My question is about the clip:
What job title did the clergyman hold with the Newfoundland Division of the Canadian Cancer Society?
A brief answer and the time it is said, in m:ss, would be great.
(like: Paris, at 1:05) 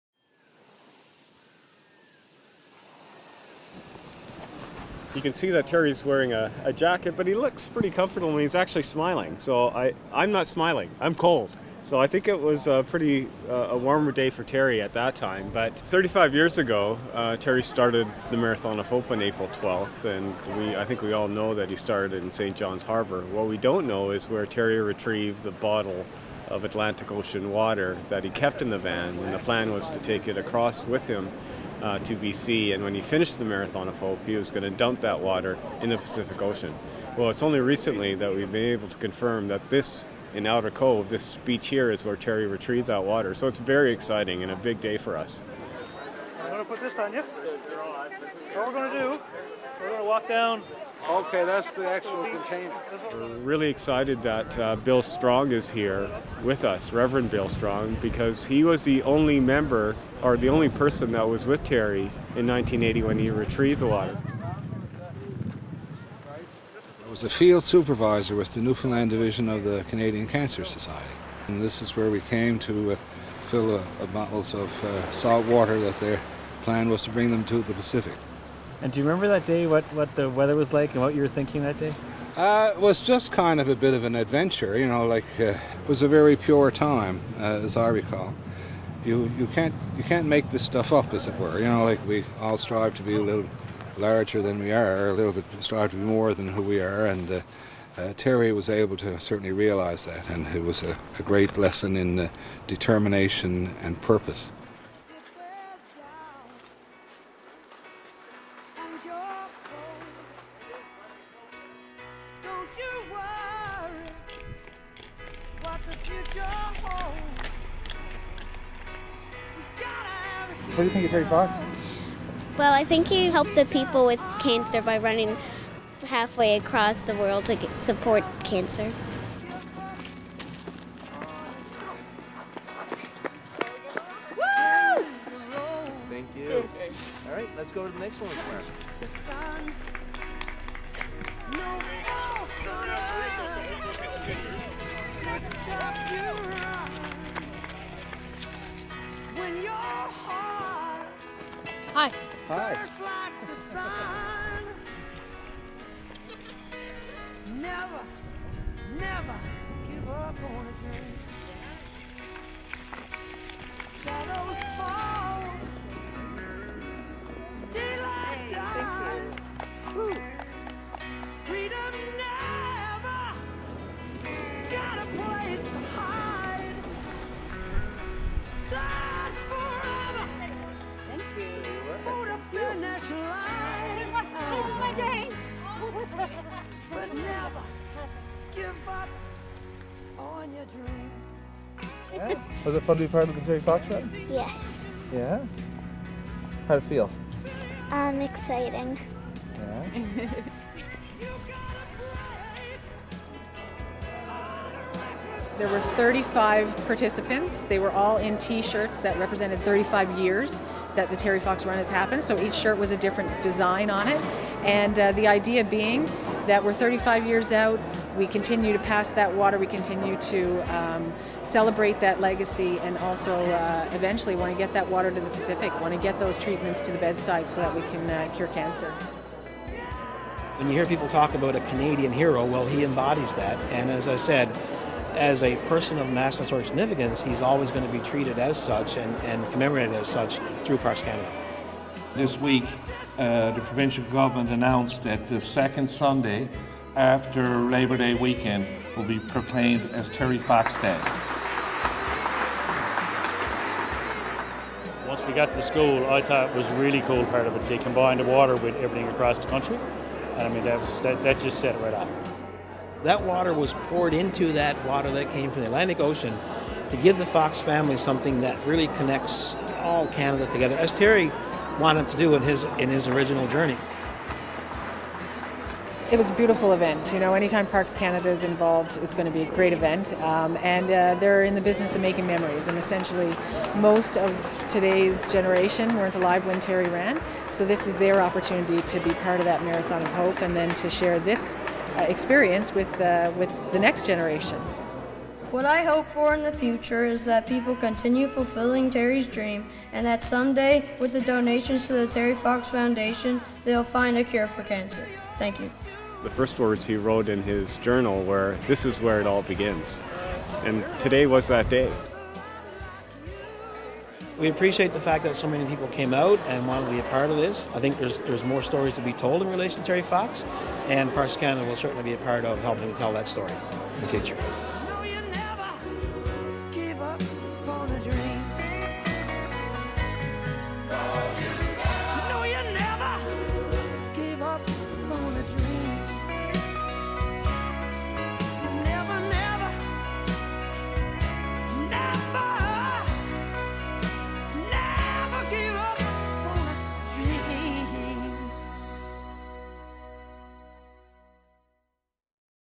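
field supervisor, at 1:07.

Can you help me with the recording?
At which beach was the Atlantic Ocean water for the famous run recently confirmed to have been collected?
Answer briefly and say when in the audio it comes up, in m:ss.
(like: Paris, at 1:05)
Outer Cove, at 0:40.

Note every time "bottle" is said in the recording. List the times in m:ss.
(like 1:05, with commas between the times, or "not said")
0:25, 1:14.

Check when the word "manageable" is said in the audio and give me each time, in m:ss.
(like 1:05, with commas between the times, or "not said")
not said.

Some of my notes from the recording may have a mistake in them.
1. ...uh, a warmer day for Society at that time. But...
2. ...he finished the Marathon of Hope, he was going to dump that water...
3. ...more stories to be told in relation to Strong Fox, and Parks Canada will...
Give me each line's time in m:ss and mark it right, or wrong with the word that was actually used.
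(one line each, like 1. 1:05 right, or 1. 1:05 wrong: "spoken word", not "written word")
1. 0:13 wrong: "Terry", not "Society"
2. 0:32 right
3. 5:18 wrong: "Terry", not "Strong".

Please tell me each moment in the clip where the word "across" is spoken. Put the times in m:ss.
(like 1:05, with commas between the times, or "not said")
0:30, 2:06, 4:19.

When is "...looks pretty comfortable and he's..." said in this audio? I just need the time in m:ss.
0:07.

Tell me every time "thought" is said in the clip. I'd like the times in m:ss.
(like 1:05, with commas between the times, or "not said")
4:16.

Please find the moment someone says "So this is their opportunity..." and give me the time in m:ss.
4:47.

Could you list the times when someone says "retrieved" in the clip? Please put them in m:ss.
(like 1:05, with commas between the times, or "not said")
0:24, 0:42, 1:03.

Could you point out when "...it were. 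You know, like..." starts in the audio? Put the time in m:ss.
1:31.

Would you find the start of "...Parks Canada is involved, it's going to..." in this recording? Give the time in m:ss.
4:37.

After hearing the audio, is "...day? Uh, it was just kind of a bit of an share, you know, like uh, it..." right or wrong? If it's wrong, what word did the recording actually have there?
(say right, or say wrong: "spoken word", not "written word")
wrong: "adventure", not "share".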